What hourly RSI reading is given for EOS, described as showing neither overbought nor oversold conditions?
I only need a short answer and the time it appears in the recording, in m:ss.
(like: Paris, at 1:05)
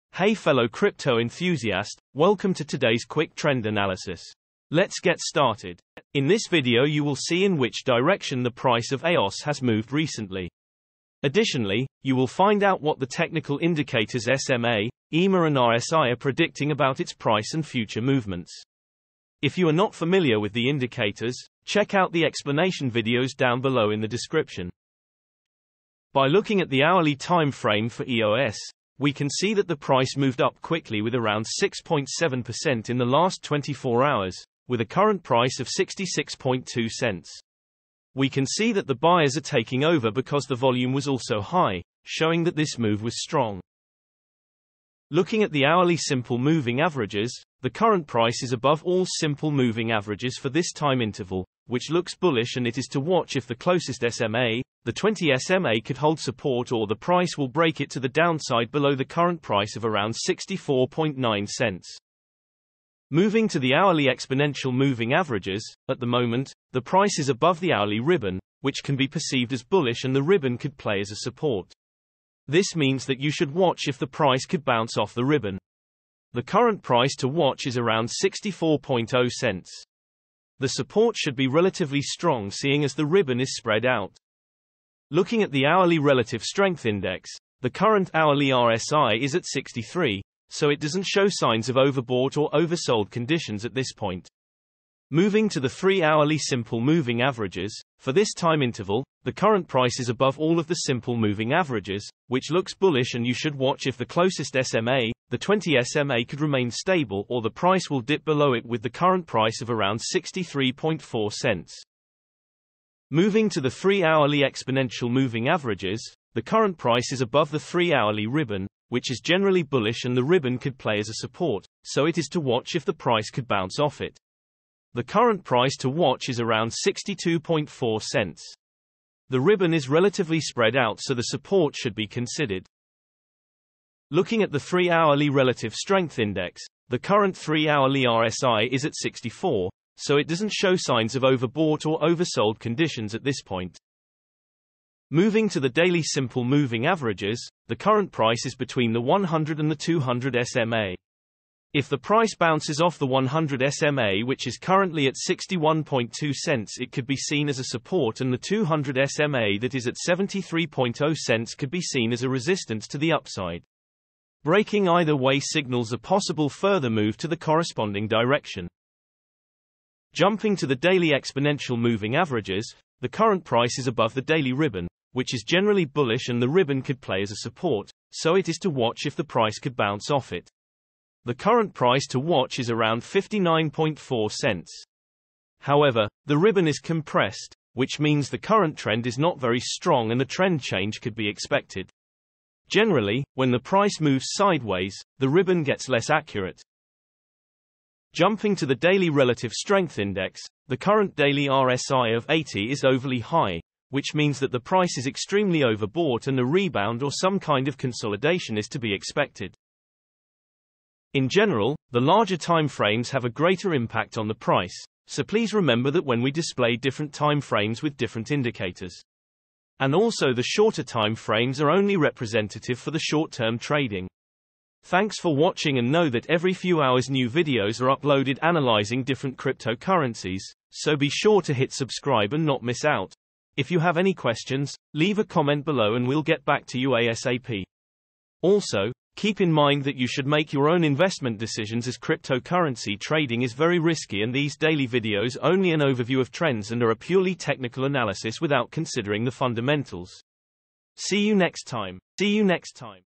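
63, at 1:29.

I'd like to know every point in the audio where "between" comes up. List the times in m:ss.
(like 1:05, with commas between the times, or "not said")
2:28.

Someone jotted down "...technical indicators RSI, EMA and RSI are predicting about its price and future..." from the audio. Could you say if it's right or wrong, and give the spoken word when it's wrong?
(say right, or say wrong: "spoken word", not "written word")
wrong: "SMA", not "RSI".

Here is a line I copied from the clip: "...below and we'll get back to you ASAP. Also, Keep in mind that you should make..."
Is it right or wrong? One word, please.
right.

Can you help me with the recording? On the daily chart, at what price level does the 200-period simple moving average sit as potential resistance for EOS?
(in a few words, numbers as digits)
73.0 cents.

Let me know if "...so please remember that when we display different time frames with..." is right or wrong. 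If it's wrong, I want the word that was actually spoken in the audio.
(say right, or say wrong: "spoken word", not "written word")
right.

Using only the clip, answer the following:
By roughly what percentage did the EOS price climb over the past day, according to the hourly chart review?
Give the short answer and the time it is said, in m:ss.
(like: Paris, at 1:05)
6.7%, at 0:31.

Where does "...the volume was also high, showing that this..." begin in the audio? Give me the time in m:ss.
0:40.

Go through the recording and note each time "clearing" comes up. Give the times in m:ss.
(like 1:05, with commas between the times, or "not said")
not said.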